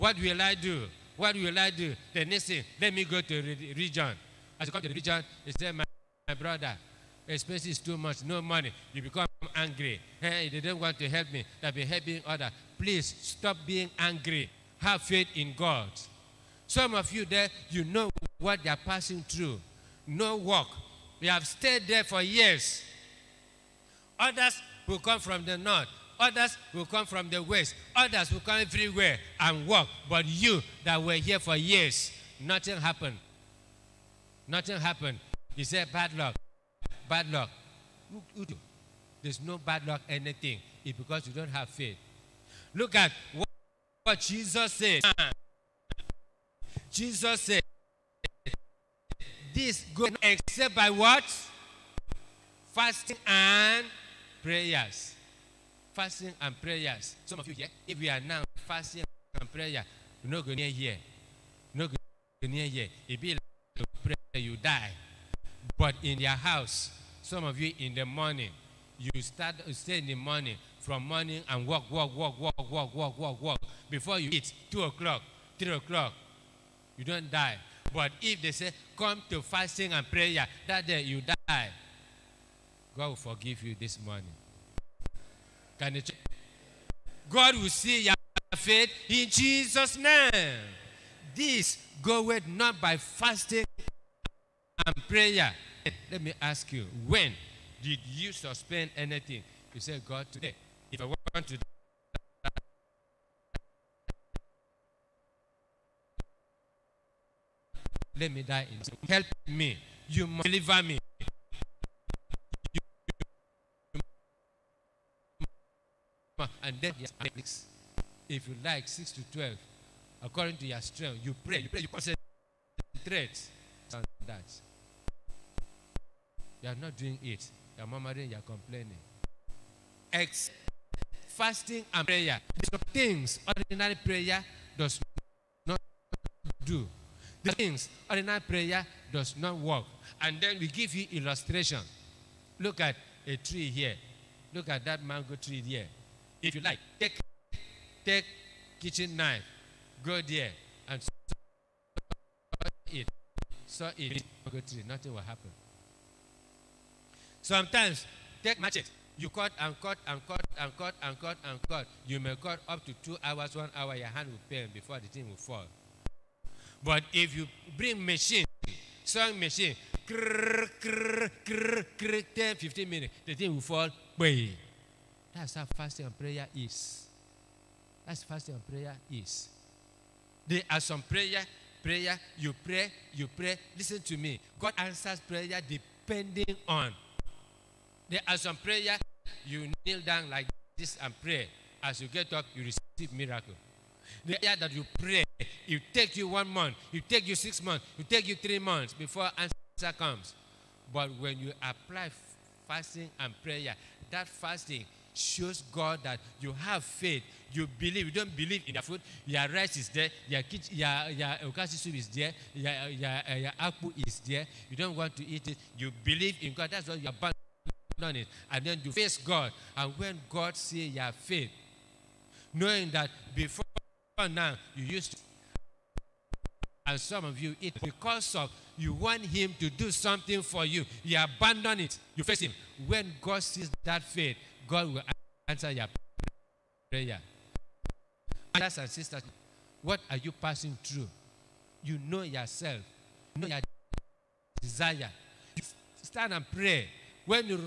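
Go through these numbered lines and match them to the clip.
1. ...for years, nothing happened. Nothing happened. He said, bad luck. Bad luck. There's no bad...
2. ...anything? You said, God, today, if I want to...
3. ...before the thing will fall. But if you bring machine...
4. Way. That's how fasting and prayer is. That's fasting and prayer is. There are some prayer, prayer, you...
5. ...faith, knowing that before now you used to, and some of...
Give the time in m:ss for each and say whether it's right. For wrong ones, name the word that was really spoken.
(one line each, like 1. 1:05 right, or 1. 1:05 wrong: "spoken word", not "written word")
1. 0:31 right
2. 1:38 right
3. 2:44 right
4. 2:54 right
5. 3:41 right.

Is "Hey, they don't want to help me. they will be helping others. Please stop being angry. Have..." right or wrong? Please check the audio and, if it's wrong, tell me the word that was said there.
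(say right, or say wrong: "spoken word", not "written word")
right.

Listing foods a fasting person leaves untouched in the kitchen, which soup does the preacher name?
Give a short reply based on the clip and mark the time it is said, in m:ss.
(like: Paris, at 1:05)
okazi soup, at 3:31.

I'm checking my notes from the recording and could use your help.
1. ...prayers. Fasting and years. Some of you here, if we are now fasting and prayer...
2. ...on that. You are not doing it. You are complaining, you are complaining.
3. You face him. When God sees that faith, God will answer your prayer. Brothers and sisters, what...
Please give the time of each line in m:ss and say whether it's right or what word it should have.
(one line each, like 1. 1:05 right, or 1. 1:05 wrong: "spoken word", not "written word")
1. 0:54 wrong: "prayers", not "years"
2. 2:03 wrong: "murmuring", not "complaining"
3. 3:52 right.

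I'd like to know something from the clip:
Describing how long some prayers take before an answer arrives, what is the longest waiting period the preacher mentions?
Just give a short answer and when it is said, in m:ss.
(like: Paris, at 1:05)
6 months, at 3:17.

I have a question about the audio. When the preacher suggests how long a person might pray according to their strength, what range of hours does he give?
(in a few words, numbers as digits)
6 to 12.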